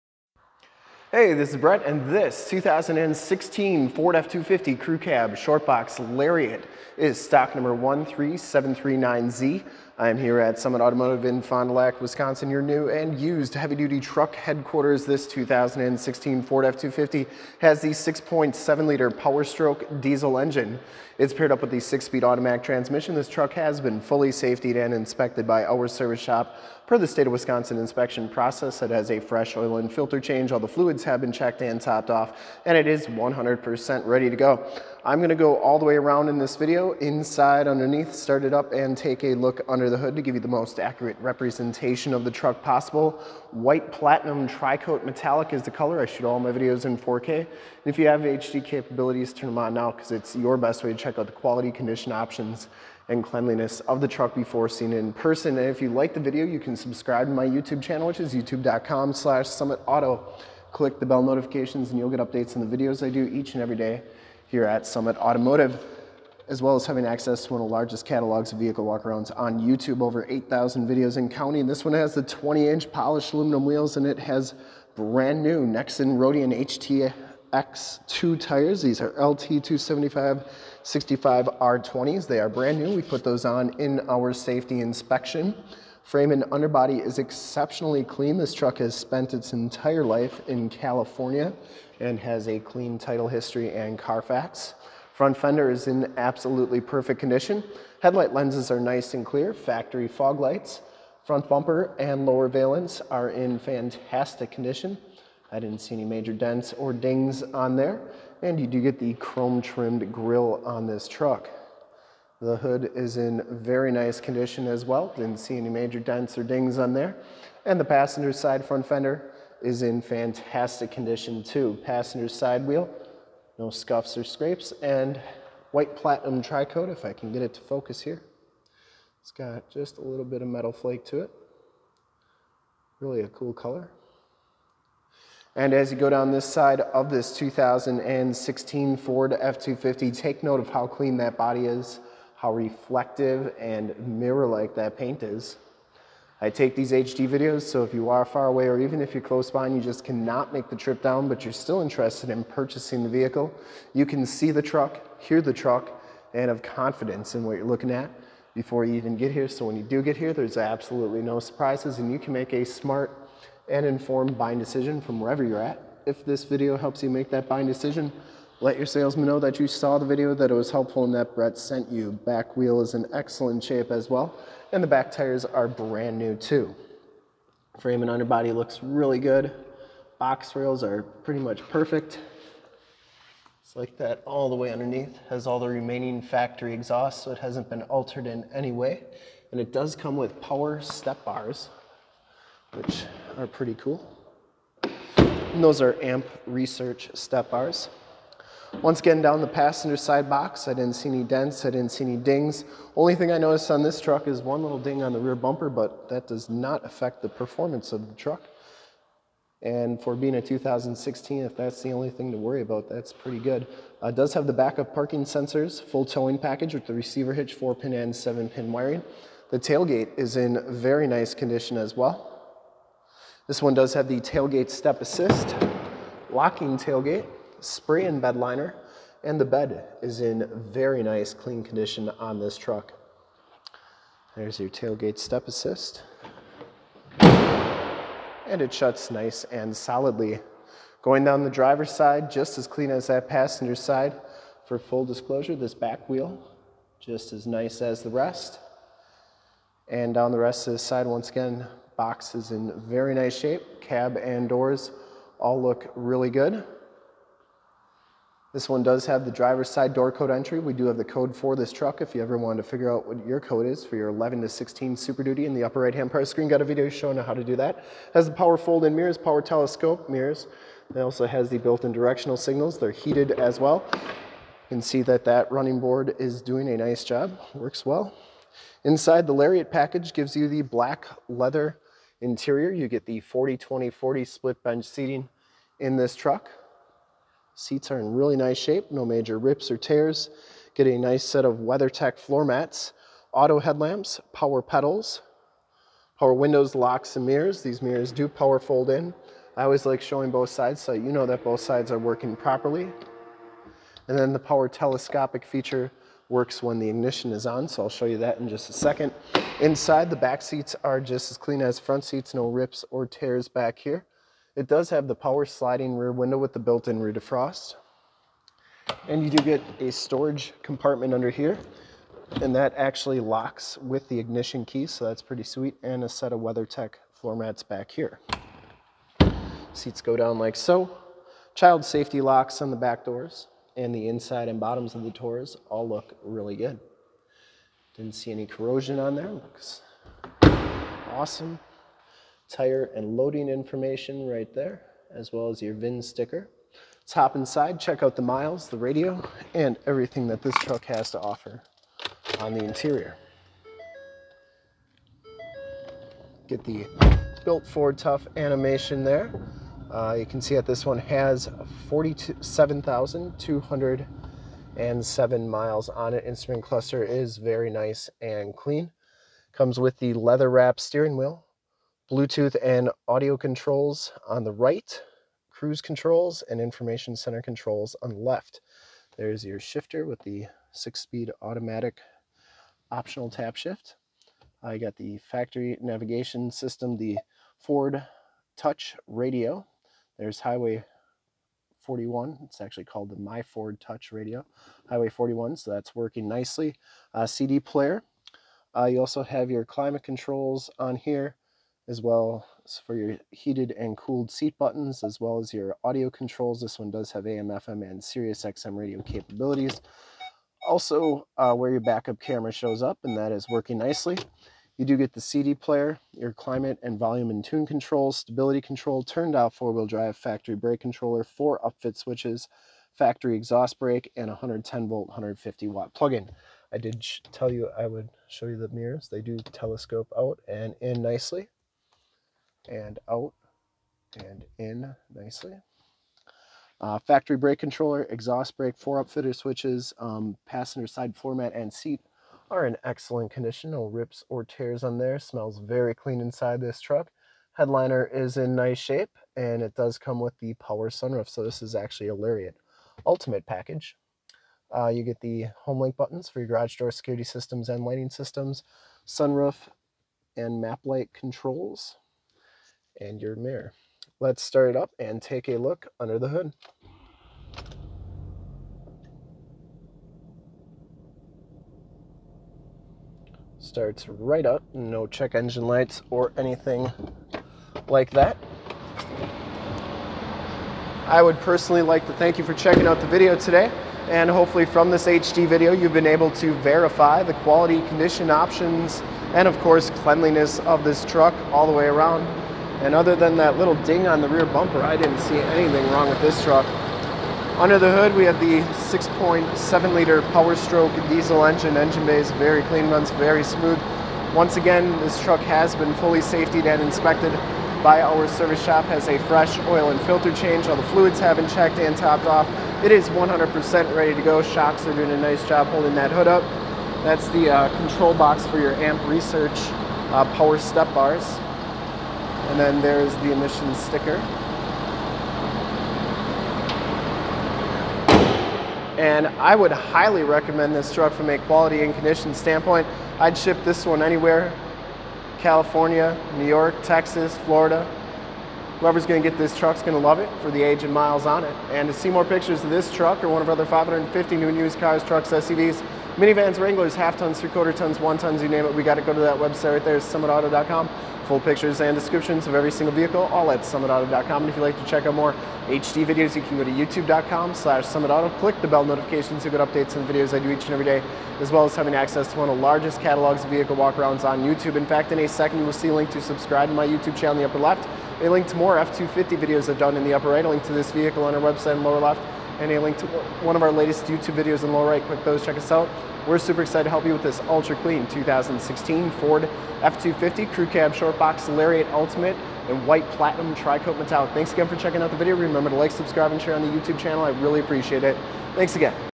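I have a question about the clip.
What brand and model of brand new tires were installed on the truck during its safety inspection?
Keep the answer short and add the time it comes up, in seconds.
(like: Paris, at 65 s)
Nexen Roadian HTX2, at 75 s.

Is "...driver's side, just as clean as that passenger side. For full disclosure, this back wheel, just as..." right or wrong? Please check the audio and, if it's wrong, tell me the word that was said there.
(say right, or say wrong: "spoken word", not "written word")
right.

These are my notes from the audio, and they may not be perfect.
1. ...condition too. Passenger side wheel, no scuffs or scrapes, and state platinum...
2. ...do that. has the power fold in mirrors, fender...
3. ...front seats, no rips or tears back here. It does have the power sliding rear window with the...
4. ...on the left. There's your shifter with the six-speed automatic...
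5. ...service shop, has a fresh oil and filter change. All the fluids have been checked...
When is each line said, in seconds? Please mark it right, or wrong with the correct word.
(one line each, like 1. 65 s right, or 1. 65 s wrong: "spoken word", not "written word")
1. 120 s wrong: "white", not "state"
2. 267 s wrong: "power", not "fender"
3. 311 s right
4. 378 s right
5. 508 s right.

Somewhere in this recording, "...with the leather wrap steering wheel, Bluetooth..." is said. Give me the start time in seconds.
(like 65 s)
369 s.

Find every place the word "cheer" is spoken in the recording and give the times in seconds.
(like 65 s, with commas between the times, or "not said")
not said.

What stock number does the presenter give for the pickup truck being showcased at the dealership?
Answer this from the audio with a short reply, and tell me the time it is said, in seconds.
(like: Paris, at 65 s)
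13739Z, at 7 s.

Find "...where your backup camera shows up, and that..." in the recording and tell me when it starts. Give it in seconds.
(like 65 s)
411 s.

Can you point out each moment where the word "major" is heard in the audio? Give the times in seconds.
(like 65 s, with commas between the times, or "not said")
106 s, 115 s, 289 s.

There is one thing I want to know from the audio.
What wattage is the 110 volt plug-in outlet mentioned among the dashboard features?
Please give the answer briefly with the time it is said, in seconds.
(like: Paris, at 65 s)
150 watts, at 425 s.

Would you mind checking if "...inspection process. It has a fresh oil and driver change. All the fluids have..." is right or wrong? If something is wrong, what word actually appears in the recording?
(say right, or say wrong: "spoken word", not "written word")
wrong: "filter", not "driver".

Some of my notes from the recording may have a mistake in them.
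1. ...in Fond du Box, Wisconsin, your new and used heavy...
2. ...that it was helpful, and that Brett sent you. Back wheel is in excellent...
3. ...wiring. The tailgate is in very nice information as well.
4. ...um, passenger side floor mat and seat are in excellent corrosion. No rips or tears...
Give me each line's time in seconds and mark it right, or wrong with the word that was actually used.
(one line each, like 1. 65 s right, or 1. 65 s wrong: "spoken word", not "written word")
1. 11 s wrong: "Lac", not "Box"
2. 170 s right
3. 218 s wrong: "condition", not "information"
4. 439 s wrong: "condition", not "corrosion".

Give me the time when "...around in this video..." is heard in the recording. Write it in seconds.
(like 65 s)
35 s.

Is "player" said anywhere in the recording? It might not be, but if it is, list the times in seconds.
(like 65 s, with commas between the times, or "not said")
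397 s, 415 s.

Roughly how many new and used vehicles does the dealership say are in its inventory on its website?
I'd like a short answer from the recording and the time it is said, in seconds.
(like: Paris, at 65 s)
550, at 543 s.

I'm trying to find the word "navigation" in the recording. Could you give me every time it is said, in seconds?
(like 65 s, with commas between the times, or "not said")
385 s.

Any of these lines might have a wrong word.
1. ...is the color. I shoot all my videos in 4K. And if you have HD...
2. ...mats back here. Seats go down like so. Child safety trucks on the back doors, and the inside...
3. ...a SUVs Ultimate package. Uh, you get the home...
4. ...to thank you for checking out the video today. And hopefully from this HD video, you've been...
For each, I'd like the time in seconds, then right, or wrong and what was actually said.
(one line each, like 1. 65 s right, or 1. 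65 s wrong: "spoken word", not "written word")
1. 45 s right
2. 327 s wrong: "locks", not "trucks"
3. 452 s wrong: "Lariat", not "SUVs"
4. 482 s right.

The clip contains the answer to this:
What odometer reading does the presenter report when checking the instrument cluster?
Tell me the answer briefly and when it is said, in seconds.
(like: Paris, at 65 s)
47,207 miles, at 361 s.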